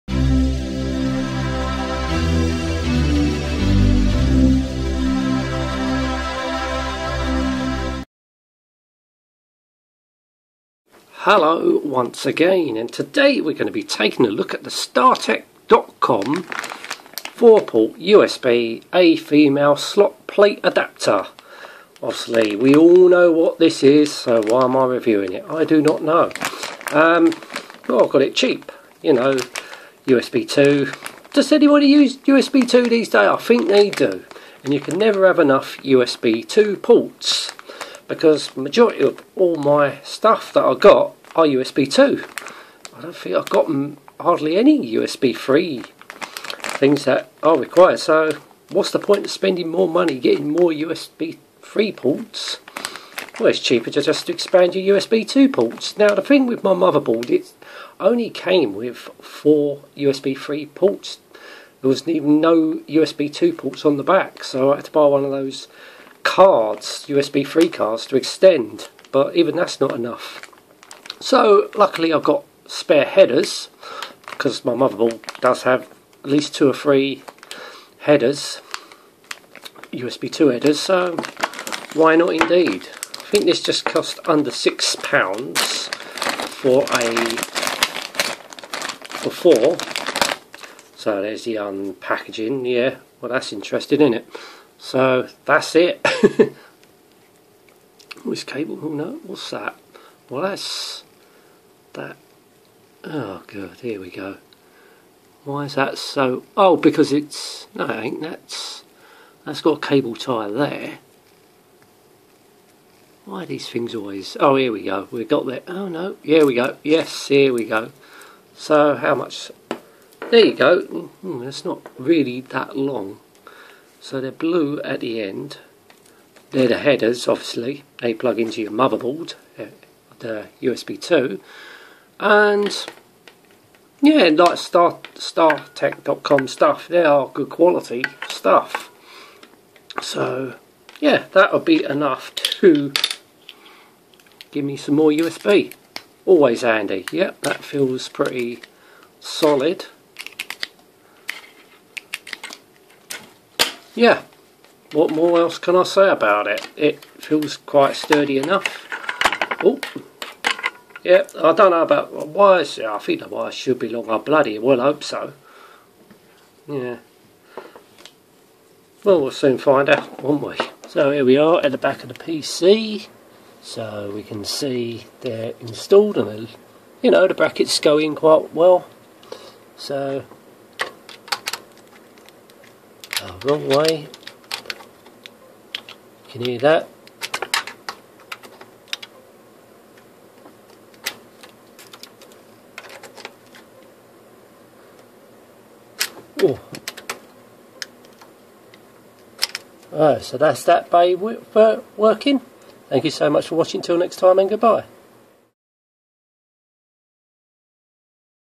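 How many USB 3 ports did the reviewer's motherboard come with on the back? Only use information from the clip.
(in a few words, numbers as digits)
4.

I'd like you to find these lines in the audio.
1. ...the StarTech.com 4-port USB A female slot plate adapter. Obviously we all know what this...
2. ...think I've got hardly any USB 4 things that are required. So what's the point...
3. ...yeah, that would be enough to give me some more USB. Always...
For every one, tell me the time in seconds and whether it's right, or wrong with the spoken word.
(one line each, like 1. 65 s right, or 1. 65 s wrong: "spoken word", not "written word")
1. 14 s right
2. 43 s wrong: "3", not "4"
3. 140 s right.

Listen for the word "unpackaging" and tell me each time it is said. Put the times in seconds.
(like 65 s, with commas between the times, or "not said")
91 s.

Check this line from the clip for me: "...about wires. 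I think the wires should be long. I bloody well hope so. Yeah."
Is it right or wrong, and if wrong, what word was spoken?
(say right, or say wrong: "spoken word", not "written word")
right.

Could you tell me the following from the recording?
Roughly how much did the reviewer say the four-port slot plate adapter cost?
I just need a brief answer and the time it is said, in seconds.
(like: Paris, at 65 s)
under 6 pounds, at 84 s.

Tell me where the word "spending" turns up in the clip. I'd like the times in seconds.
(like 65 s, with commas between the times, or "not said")
49 s.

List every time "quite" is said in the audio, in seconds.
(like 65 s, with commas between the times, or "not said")
157 s, 178 s.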